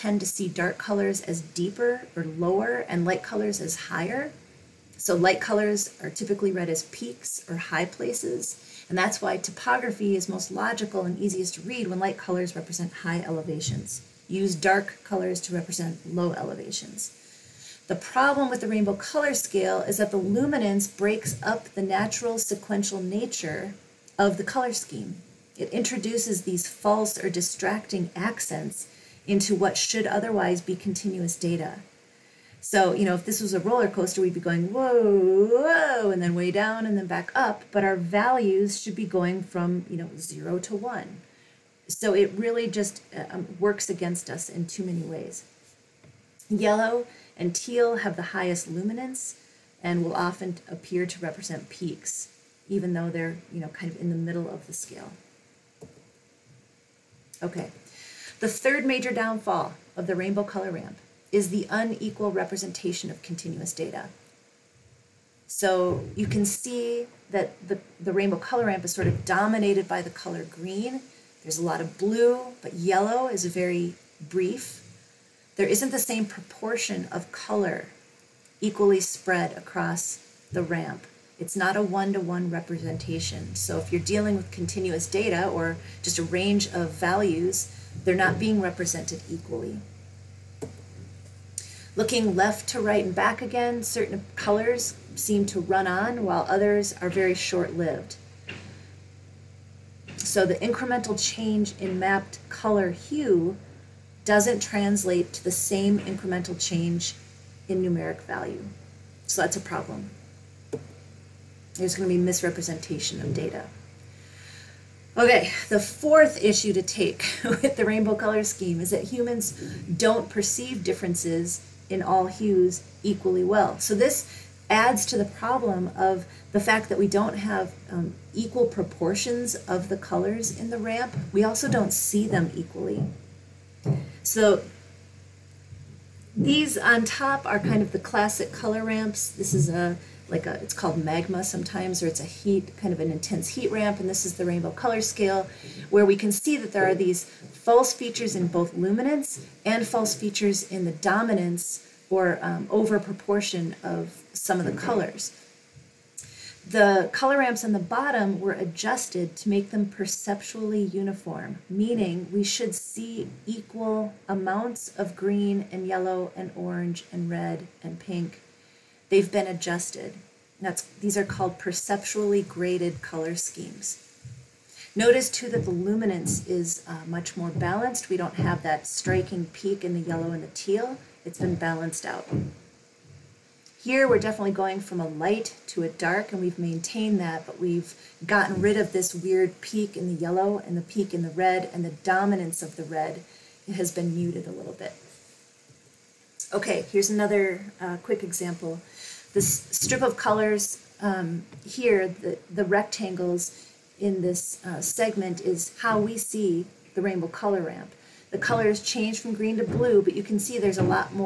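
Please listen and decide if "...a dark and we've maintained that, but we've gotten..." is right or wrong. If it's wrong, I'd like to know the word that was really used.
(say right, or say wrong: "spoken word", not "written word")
right.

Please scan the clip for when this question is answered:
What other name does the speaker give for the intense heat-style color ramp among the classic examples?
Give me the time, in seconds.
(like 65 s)
141 s.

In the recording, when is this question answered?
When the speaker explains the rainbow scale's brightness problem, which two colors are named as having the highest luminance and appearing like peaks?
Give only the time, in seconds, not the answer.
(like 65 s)
46 s.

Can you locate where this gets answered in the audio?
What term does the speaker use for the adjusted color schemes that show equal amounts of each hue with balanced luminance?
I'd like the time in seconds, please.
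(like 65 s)
171 s.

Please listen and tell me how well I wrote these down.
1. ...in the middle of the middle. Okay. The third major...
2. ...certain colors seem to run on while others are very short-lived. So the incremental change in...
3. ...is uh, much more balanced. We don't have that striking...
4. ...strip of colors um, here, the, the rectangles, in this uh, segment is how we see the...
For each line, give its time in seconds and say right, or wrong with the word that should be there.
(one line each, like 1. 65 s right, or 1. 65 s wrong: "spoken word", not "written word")
1. 53 s wrong: "scale", not "middle"
2. 93 s right
3. 176 s right
4. 199 s right.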